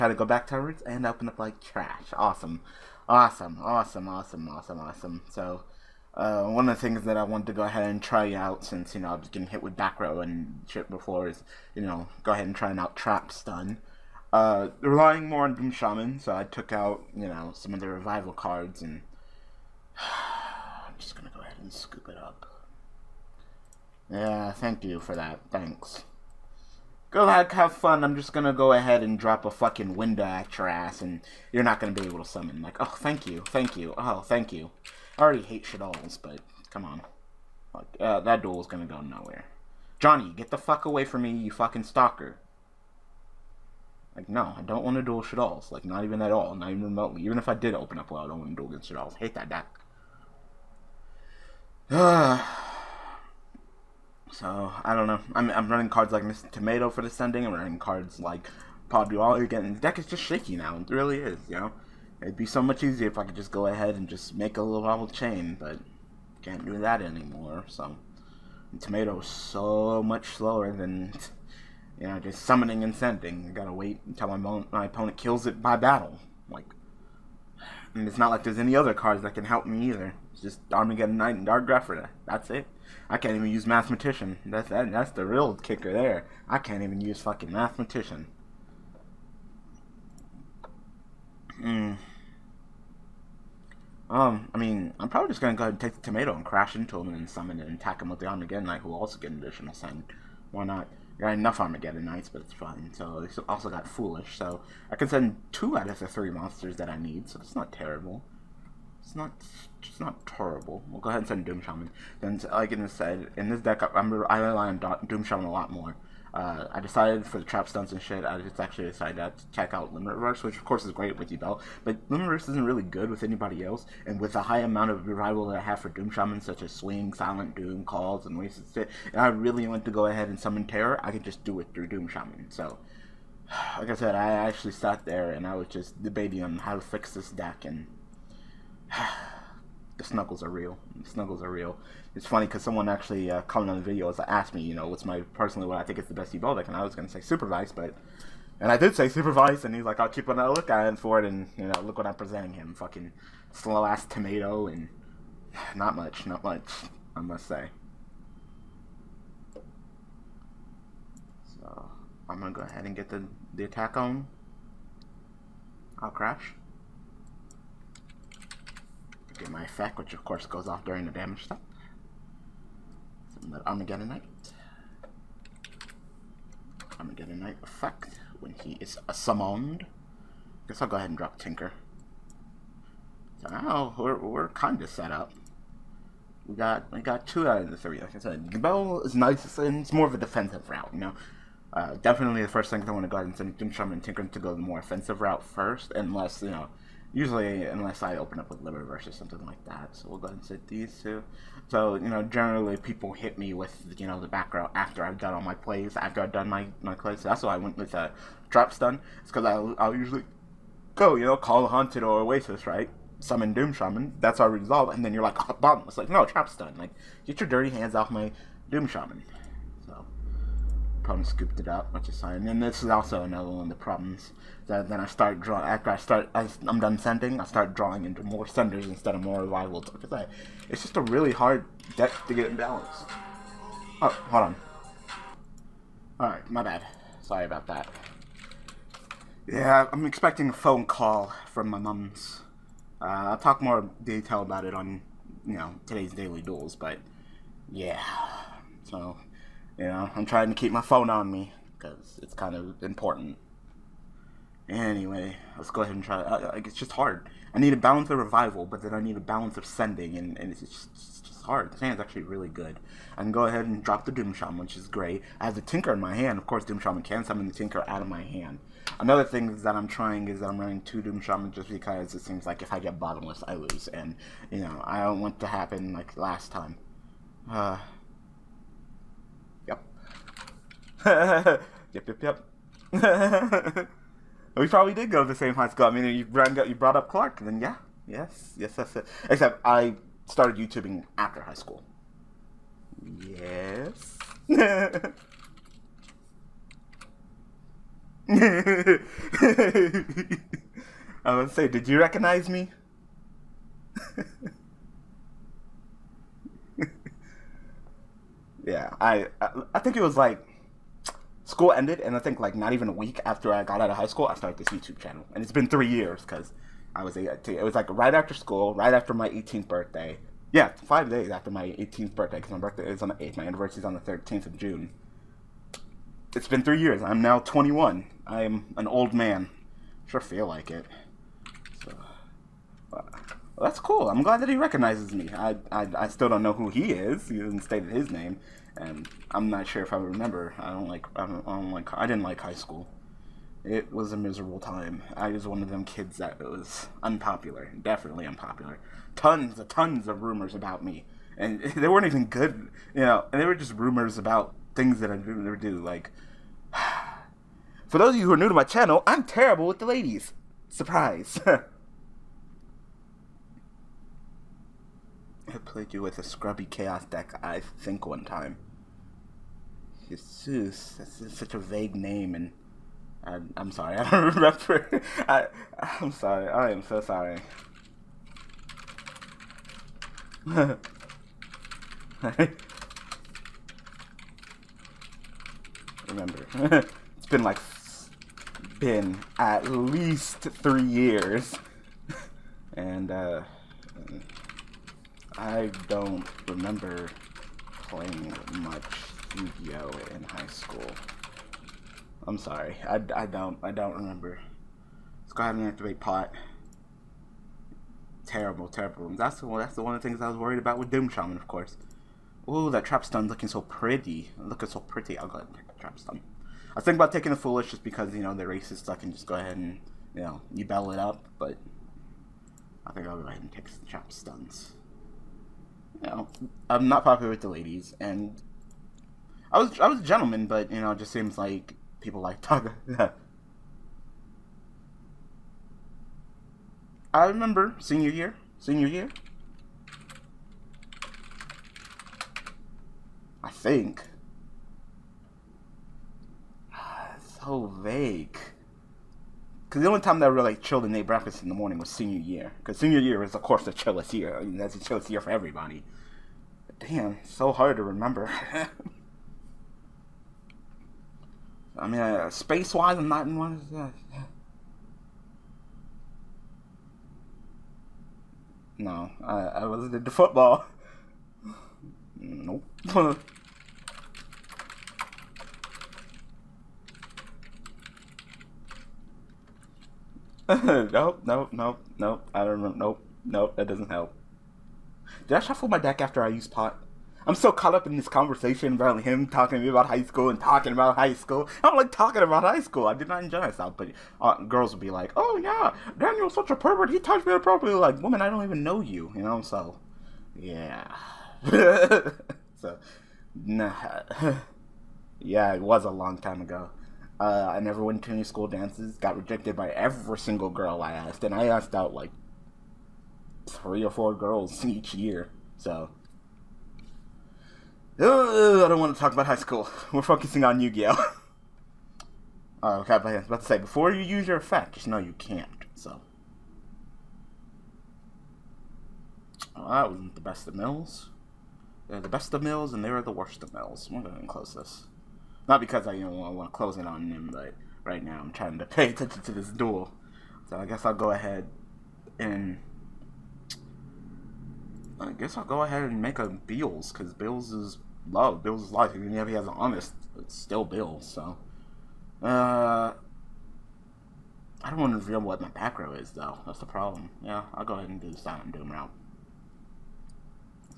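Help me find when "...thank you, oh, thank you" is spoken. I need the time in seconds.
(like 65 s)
33 s.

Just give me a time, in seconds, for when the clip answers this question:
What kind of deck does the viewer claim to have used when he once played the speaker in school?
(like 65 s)
366 s.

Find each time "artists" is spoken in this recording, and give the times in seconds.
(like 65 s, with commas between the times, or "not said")
not said.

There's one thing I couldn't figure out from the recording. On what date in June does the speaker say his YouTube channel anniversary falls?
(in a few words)
13th of June.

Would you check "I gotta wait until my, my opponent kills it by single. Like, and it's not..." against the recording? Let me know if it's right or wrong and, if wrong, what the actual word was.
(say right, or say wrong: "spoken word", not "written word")
wrong: "battle", not "single".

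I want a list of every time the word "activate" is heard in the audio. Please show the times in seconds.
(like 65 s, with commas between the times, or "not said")
405 s.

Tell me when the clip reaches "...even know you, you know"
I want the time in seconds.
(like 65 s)
498 s.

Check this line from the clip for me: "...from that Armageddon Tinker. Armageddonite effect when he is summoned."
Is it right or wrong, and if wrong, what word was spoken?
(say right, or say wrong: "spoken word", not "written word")
wrong: "Knight", not "Tinker".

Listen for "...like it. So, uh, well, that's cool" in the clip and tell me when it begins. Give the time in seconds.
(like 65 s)
330 s.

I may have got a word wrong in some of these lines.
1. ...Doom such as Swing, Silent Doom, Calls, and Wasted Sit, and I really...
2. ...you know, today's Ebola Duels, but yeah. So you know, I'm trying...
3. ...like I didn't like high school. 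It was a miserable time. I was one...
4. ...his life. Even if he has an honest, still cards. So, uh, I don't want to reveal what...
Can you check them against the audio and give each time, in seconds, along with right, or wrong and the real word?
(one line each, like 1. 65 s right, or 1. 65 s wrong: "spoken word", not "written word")
1. 125 s right
2. 245 s wrong: "Daily", not "Ebola"
3. 341 s right
4. 548 s wrong: "builds", not "cards".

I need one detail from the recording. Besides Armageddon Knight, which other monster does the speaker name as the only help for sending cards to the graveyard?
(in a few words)
Dark Grepher.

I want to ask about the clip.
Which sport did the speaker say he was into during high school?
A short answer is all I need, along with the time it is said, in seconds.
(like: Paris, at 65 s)
football, at 470 s.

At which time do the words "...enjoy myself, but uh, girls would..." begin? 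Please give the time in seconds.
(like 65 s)
493 s.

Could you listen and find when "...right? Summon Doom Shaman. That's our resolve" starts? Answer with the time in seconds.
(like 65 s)
212 s.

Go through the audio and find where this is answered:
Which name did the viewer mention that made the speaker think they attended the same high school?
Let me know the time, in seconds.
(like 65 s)
287 s.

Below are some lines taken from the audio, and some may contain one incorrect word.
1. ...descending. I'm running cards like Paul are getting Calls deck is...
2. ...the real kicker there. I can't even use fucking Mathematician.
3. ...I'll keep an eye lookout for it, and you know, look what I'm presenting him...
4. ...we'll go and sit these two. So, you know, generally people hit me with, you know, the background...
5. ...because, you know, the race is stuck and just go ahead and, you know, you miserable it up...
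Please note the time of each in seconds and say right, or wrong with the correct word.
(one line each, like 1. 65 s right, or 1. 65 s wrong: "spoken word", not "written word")
1. 57 s wrong: "The", not "Calls"
2. 85 s right
3. 150 s right
4. 200 s right
5. 417 s wrong: "battle", not "miserable".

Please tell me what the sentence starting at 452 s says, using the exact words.
Because senior year is, of course, the chillest year.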